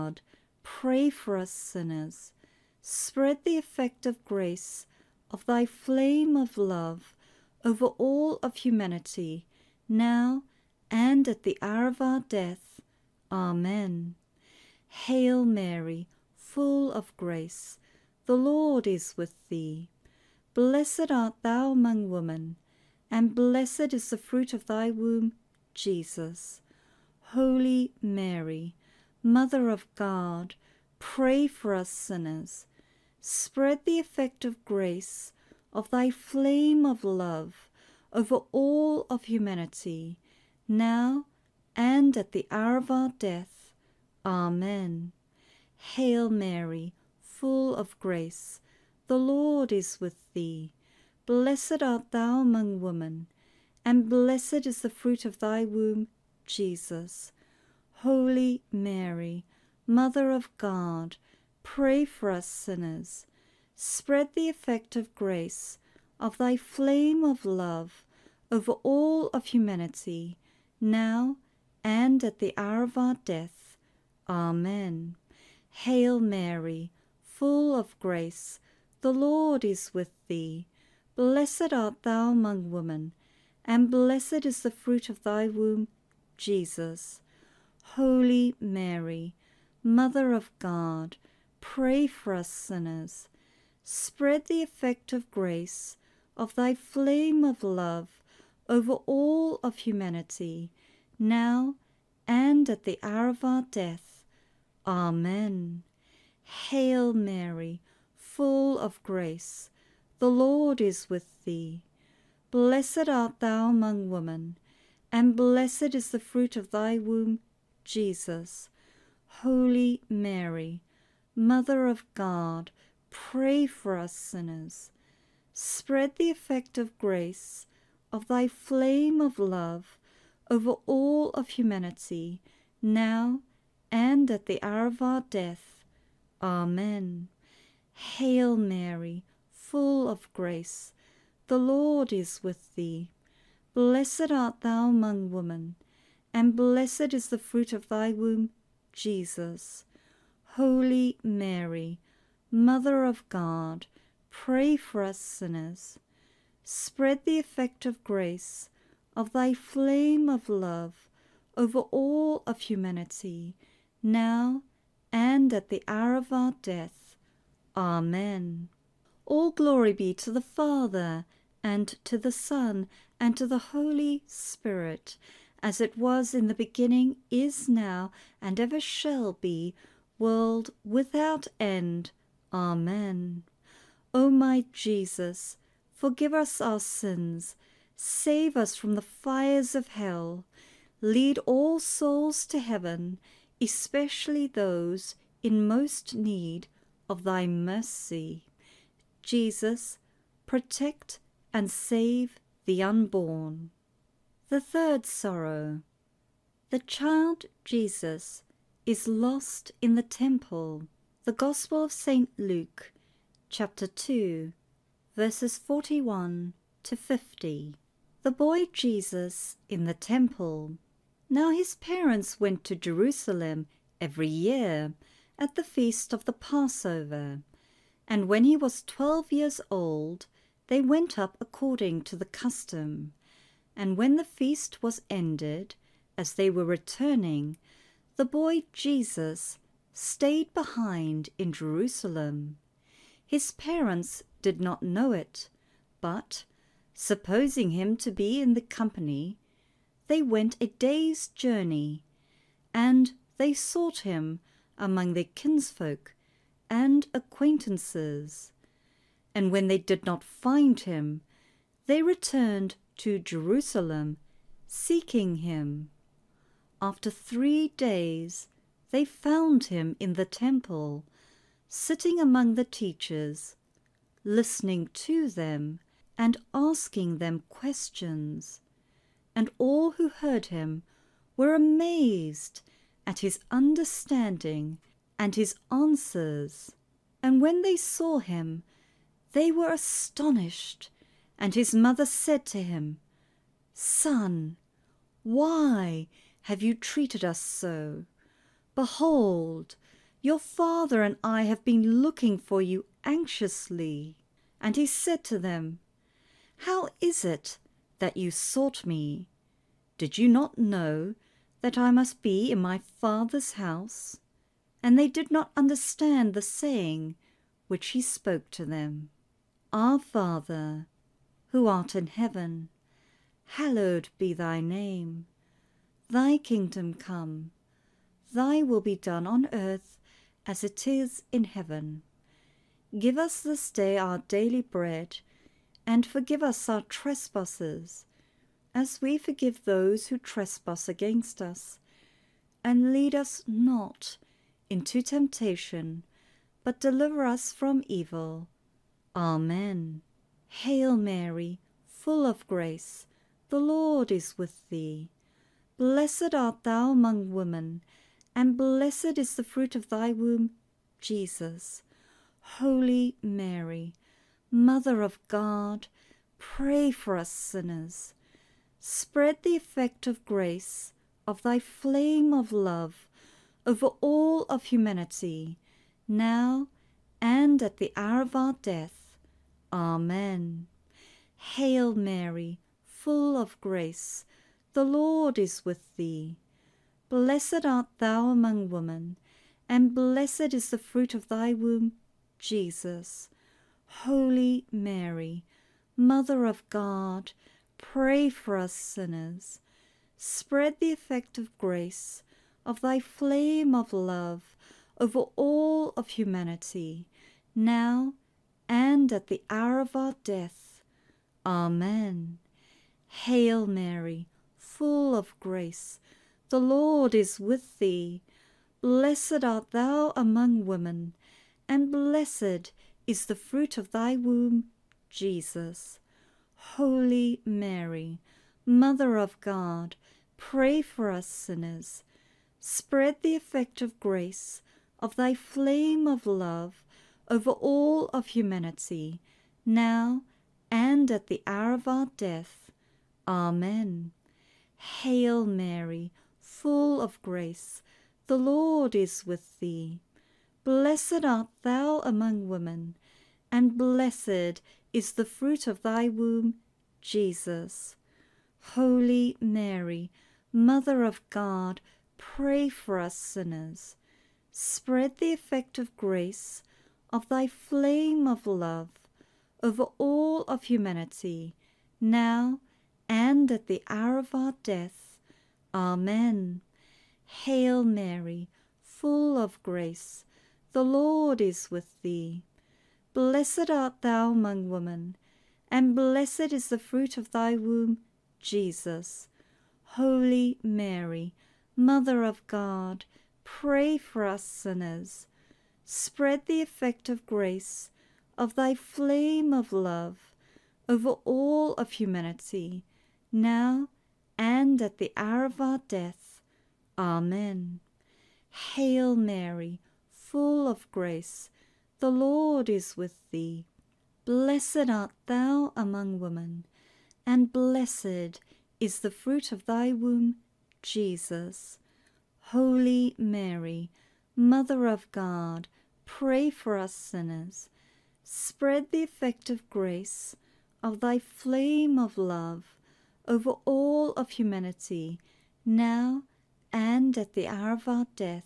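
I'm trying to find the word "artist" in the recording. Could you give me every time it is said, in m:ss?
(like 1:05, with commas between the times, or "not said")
not said.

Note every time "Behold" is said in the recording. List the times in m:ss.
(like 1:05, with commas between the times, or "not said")
4:58.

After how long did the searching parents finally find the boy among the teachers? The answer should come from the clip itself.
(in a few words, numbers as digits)
3 days.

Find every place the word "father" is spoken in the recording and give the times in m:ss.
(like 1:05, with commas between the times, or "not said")
2:50, 5:00, 5:12, 5:19.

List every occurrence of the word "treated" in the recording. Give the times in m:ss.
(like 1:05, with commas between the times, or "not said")
4:56.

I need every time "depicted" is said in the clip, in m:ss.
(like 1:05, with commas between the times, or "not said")
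not said.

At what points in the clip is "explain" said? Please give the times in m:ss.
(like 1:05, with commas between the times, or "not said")
not said.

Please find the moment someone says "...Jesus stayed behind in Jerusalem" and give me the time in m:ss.
3:58.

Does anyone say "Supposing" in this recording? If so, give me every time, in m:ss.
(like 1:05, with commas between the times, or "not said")
4:06.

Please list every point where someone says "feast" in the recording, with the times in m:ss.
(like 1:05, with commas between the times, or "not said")
3:45, 3:54.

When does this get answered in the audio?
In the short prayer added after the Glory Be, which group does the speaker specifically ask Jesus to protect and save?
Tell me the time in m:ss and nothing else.
3:22.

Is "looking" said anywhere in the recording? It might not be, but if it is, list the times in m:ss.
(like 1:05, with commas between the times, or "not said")
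5:02.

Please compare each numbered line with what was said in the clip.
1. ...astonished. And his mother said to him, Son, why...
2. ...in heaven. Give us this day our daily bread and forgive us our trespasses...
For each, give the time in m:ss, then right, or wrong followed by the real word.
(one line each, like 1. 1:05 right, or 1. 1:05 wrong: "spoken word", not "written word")
1. 4:49 right
2. 5:31 right.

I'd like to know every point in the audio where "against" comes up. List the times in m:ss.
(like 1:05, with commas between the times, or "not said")
5:40.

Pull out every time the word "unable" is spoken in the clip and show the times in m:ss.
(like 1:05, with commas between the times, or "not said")
not said.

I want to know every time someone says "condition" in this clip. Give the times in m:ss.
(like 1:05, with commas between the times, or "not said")
not said.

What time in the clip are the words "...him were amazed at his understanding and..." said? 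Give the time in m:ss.
4:40.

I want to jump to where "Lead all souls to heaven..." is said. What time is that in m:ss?
3:11.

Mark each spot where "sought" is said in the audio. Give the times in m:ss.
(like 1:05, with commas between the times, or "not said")
4:13, 5:08.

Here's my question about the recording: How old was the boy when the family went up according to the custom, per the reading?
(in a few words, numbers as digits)
12.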